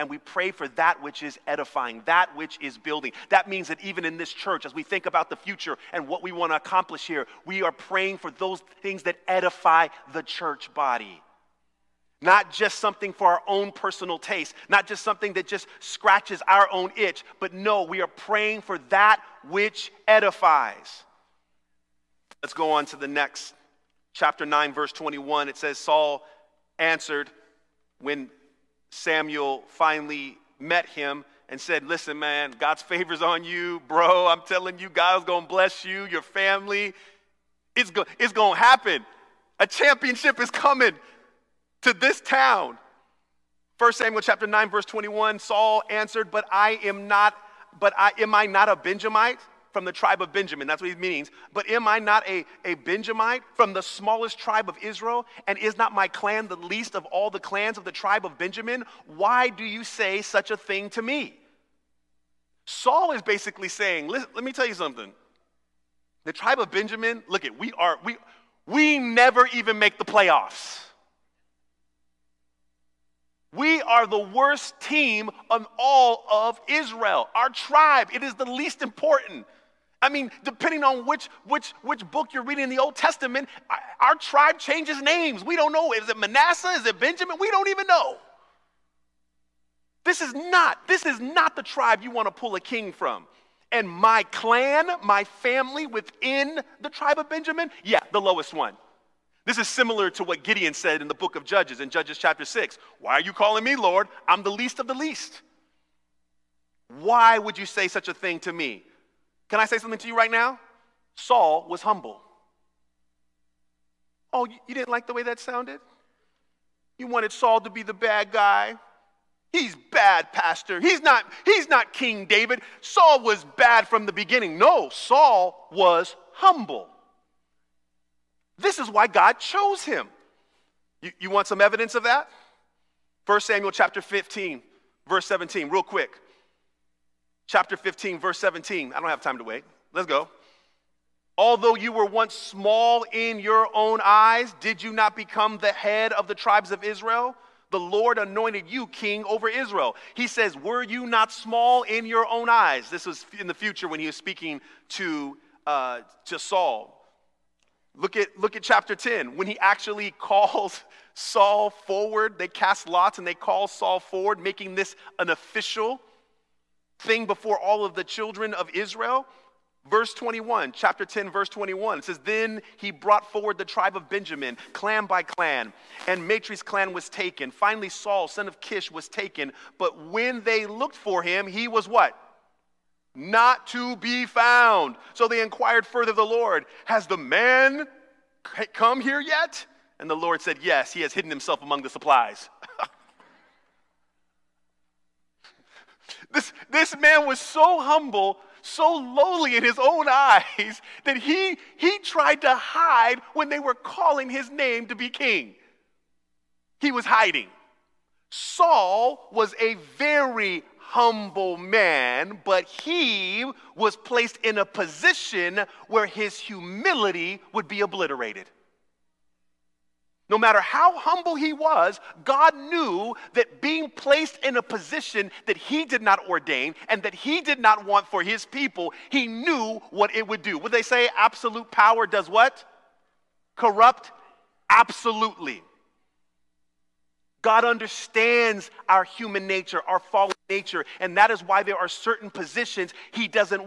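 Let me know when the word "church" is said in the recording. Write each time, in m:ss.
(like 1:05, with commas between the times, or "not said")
0:04, 0:10.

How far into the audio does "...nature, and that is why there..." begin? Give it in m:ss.
4:00.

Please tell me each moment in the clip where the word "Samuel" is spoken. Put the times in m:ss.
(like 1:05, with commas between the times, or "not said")
0:28, 0:43, 2:13.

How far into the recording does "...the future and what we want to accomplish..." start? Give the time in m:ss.
0:05.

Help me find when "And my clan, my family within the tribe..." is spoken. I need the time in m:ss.
1:33.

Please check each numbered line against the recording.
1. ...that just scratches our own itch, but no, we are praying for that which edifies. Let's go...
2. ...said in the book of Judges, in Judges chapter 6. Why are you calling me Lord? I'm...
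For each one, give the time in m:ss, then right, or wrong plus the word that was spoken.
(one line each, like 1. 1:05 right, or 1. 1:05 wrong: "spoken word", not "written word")
1. 0:15 right
2. 1:40 right.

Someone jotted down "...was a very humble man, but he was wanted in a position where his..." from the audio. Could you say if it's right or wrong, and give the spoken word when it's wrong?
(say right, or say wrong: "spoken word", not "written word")
wrong: "placed", not "wanted".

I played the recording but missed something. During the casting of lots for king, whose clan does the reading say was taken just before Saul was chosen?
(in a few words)
Matri's clan.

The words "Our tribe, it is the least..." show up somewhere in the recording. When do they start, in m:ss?
1:17.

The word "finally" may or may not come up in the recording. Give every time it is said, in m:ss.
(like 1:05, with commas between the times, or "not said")
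0:29, 2:57.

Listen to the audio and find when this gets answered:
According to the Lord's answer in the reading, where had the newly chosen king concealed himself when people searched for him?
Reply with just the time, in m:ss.
3:11.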